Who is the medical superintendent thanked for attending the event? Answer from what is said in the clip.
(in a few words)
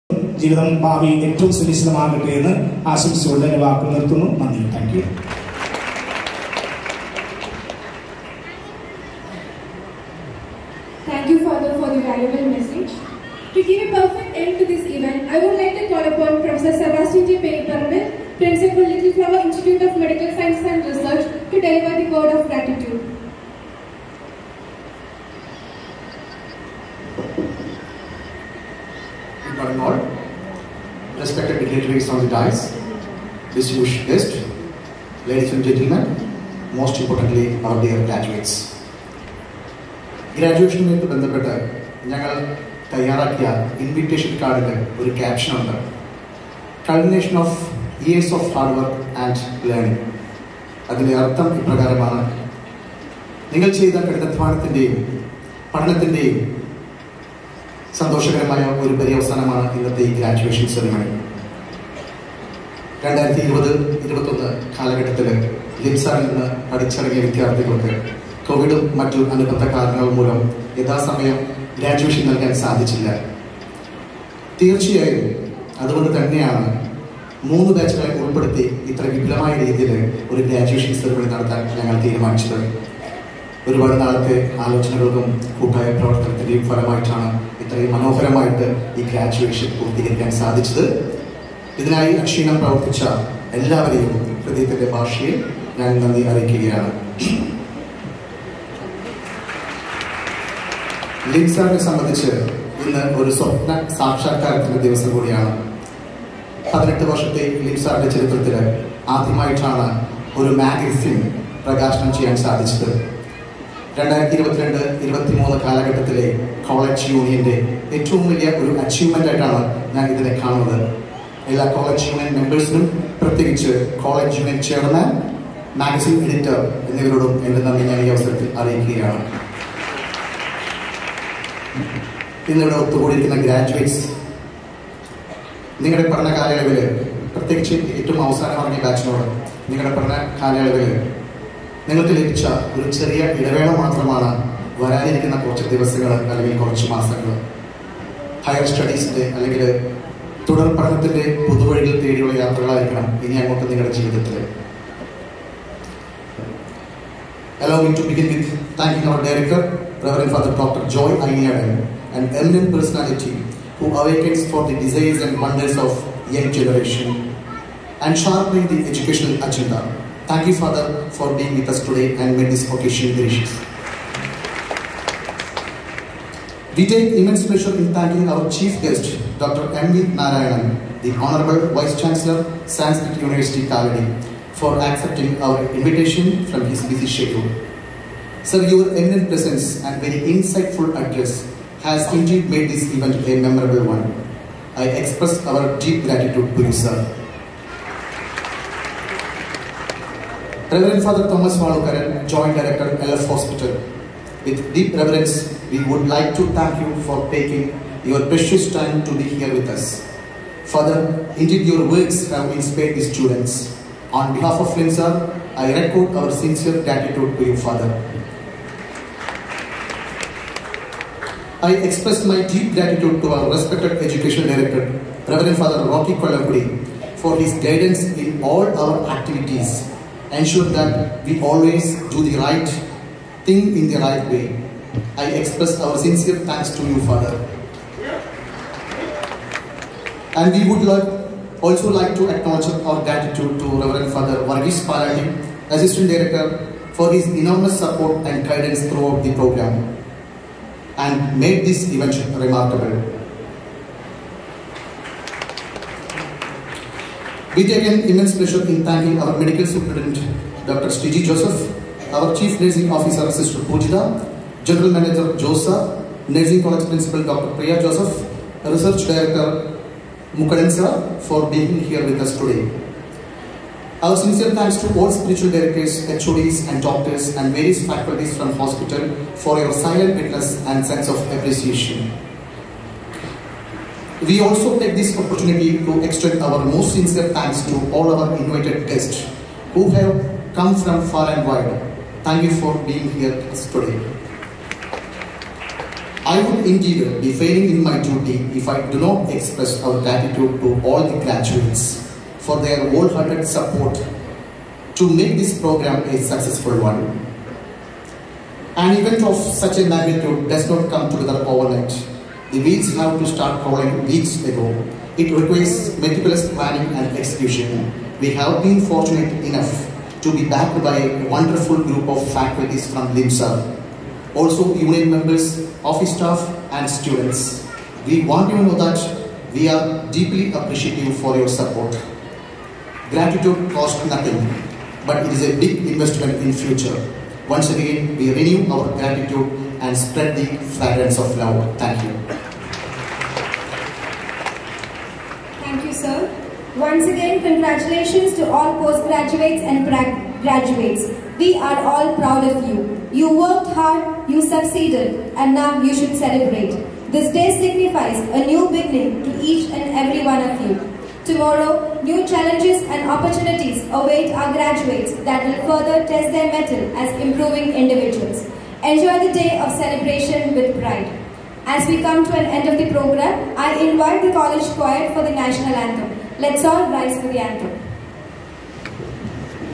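Dr. Sriji Joseph.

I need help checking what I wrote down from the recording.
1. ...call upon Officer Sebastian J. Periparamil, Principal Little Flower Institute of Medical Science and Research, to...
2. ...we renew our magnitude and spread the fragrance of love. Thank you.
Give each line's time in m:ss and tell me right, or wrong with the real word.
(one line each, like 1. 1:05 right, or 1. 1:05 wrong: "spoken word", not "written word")
1. 0:15 wrong: "Professor", not "Officer"
2. 5:38 wrong: "gratitude", not "magnitude".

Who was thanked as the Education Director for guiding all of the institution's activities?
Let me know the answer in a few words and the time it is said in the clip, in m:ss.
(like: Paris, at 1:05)
Father Rocky Kolakudi, at 3:45.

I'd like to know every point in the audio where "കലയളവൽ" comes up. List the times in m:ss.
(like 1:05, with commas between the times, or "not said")
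2:16, 2:20.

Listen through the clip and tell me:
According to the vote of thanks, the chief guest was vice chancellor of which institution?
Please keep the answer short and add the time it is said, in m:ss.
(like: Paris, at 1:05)
Sanskrit University, Kalady, at 3:02.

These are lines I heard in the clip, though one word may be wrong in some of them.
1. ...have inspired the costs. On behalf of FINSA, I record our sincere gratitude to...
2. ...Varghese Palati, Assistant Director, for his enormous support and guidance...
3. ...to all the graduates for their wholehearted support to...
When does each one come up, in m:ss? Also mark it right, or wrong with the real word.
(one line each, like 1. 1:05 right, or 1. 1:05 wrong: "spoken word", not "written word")
1. 3:32 wrong: "students", not "costs"
2. 4:04 right
3. 5:00 right.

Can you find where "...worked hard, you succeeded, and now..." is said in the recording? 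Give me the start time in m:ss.
5:53.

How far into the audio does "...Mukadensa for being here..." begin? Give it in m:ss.
4:30.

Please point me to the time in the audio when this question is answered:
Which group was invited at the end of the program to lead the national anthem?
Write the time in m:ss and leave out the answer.
6:14.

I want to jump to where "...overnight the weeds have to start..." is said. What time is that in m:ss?
5:11.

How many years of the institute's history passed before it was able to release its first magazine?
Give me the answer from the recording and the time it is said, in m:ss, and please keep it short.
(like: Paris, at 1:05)
18, at 1:46.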